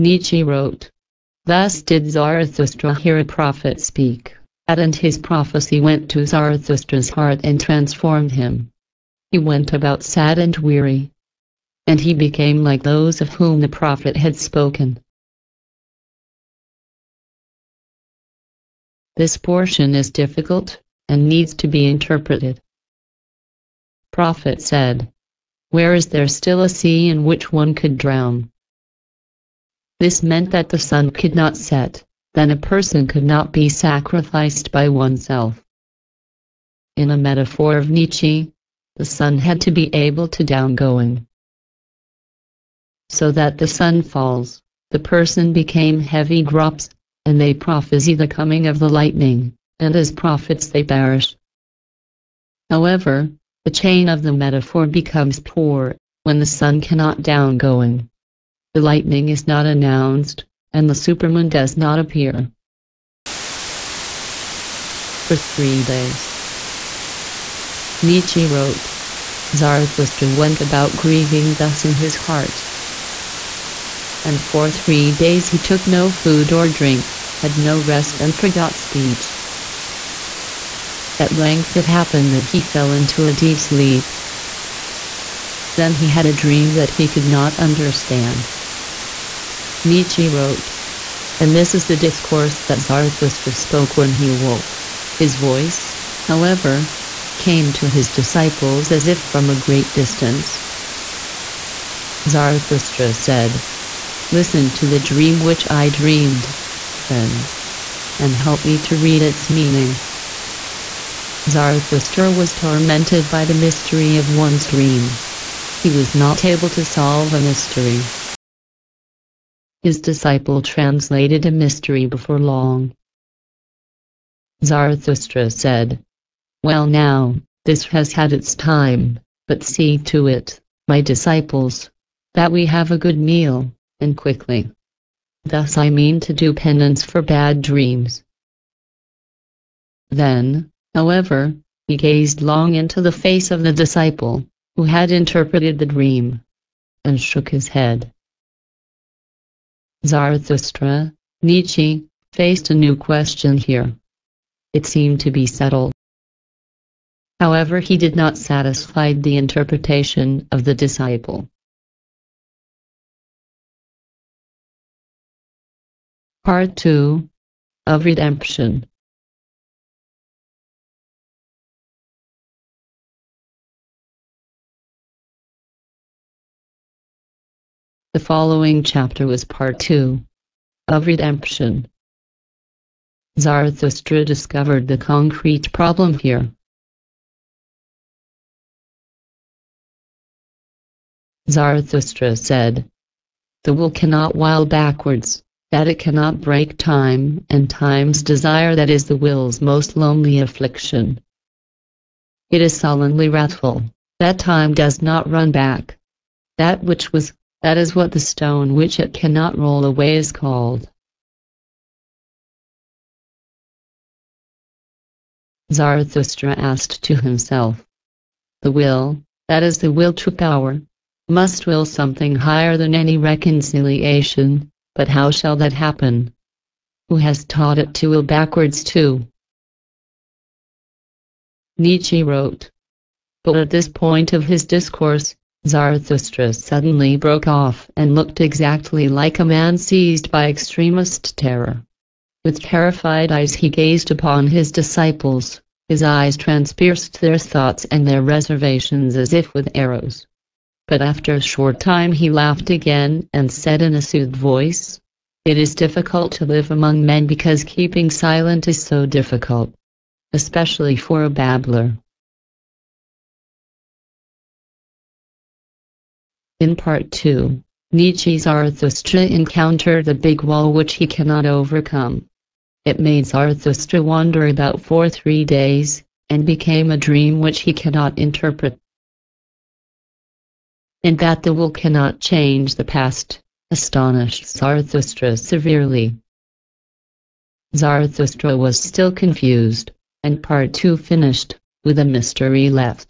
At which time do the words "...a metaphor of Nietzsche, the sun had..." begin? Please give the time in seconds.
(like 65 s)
37 s.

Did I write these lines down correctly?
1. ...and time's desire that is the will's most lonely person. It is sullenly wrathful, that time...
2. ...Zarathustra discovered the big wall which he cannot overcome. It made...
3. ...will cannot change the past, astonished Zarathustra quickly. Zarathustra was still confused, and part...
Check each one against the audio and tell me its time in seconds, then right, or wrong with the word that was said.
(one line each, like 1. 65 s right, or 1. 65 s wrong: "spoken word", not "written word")
1. 197 s wrong: "affliction", not "person"
2. 268 s wrong: "encountered", not "discovered"
3. 281 s wrong: "severely", not "quickly".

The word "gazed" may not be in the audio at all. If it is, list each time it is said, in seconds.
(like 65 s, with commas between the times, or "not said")
141 s, 243 s.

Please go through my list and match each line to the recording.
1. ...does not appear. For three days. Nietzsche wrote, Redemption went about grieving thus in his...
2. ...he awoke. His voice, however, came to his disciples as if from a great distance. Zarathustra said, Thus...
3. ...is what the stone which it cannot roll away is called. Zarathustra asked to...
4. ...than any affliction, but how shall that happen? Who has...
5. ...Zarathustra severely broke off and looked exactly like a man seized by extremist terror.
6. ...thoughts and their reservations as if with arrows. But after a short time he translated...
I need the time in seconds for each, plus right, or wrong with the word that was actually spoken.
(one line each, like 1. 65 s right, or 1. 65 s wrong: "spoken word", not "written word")
1. 61 s wrong: "Zarathustra", not "Redemption"
2. 94 s wrong: "Listen", not "Thus"
3. 207 s right
4. 222 s wrong: "reconciliation", not "affliction"
5. 235 s wrong: "suddenly", not "severely"
6. 247 s wrong: "laughed", not "translated".